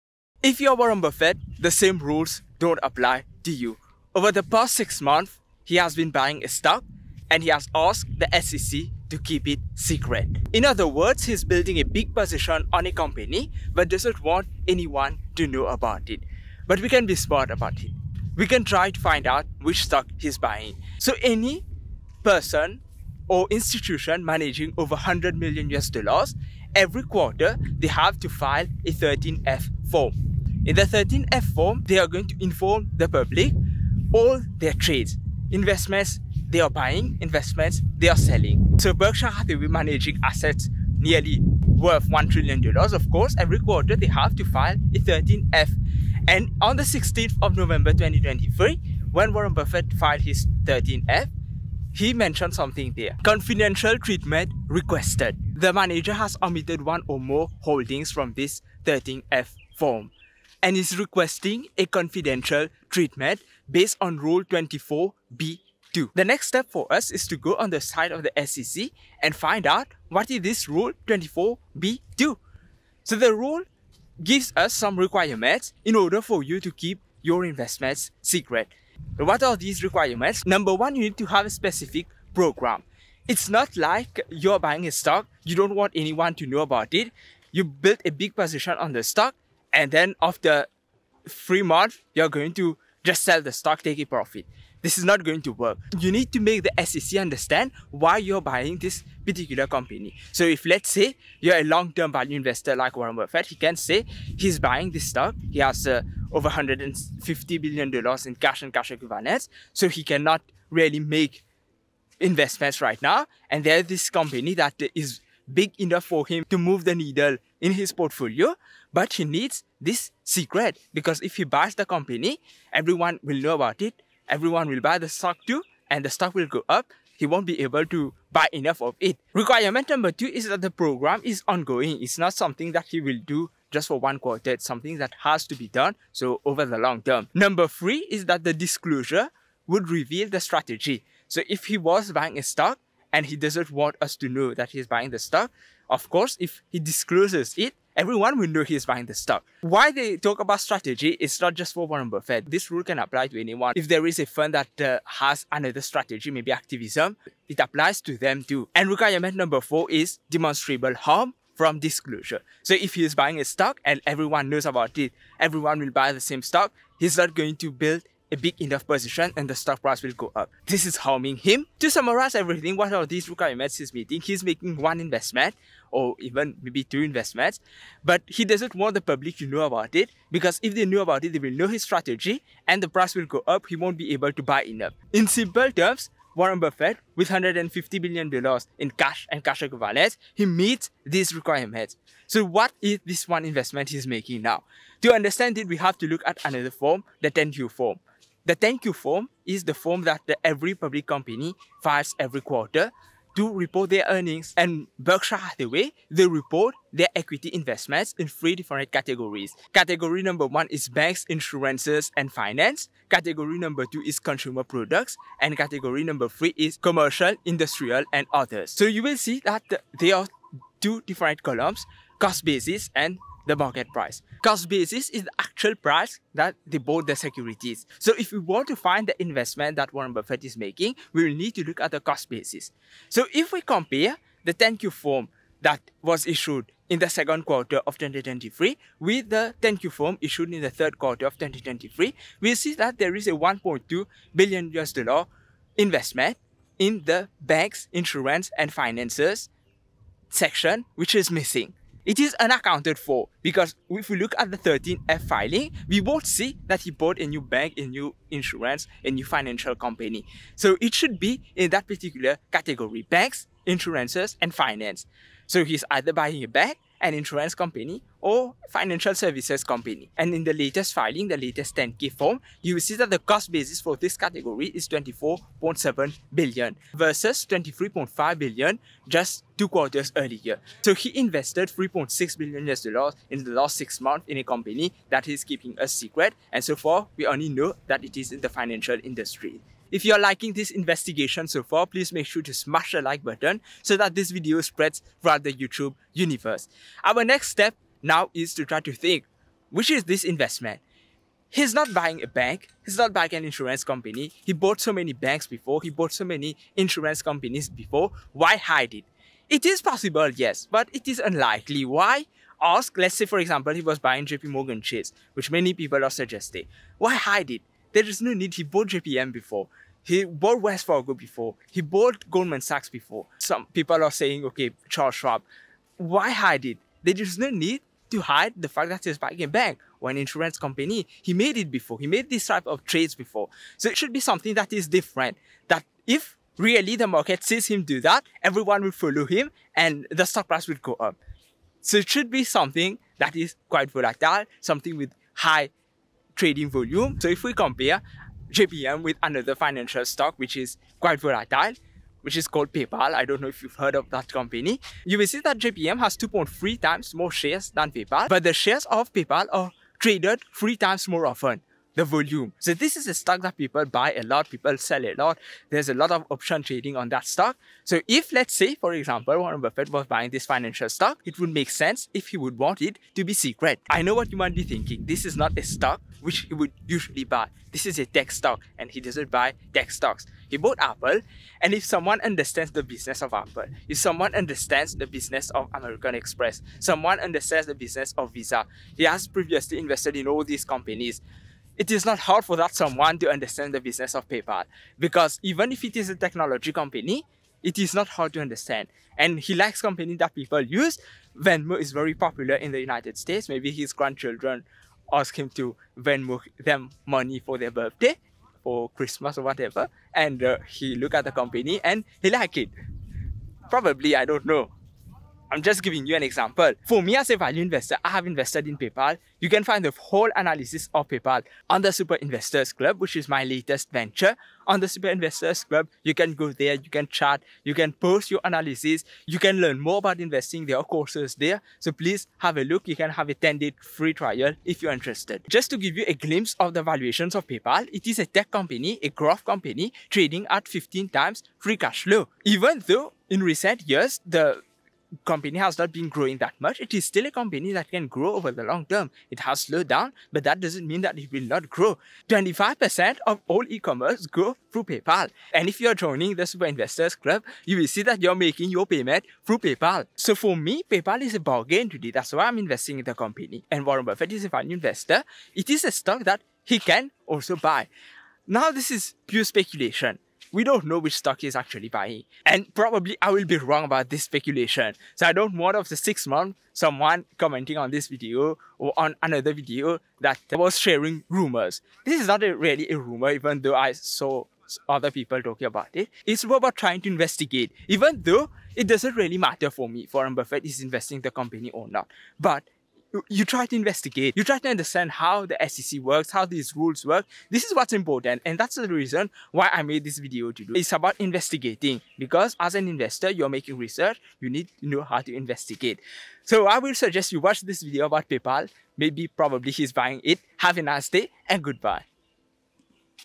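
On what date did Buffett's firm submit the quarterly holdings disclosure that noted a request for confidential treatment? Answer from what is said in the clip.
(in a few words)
16th of November 2023.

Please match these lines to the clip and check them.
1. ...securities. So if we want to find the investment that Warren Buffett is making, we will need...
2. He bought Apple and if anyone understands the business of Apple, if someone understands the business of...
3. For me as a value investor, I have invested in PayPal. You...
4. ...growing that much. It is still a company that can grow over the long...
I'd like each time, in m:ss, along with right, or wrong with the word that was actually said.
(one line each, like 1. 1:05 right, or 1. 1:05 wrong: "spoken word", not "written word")
1. 3:47 right
2. 6:20 wrong: "someone", not "anyone"
3. 6:56 right
4. 7:26 right.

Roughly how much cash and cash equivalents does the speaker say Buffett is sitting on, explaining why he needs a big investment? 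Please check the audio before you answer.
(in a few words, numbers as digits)
over 150 billion dollars.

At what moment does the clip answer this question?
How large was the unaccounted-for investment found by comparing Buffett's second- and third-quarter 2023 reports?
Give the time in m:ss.
4:03.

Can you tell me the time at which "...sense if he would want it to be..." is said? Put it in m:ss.
6:11.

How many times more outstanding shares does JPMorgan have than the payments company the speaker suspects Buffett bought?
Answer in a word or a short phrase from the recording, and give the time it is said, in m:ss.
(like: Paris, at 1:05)
2.3 times, at 5:56.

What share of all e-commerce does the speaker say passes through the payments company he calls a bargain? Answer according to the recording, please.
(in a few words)
25%.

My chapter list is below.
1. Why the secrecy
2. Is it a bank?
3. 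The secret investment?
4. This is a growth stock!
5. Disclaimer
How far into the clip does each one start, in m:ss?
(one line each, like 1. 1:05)
1. 1:06
2. 3:15
3. 4:49
4. 6:13
5. 7:48.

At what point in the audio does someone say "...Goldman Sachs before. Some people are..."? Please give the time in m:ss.
5:22.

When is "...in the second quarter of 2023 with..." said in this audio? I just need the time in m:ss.
3:56.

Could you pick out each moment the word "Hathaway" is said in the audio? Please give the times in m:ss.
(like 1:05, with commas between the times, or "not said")
0:39, 3:25.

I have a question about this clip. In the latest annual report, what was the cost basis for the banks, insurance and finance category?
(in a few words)
24.7 billion.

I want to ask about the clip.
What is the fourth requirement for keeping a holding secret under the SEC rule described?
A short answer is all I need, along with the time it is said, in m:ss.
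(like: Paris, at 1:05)
demonstrable harm from disclosure, at 2:40.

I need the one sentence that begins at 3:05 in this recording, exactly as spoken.
In simple terms, Warren Buffett with 150 billion dollars in cash and cash equivalents, he meets these requirements.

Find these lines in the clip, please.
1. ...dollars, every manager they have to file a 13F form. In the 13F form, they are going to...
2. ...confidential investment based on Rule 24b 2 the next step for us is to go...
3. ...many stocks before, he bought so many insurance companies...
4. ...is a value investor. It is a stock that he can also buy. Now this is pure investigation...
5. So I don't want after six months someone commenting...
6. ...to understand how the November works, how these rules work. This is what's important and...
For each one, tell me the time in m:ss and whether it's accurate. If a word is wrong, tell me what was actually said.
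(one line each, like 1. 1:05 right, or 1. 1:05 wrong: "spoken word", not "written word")
1. 0:25 wrong: "quarter", not "manager"
2. 1:01 wrong: "treatment", not "investment"
3. 5:04 wrong: "banks", not "stocks"
4. 7:44 wrong: "speculation", not "investigation"
5. 7:55 right
6. 8:14 wrong: "SEC", not "November".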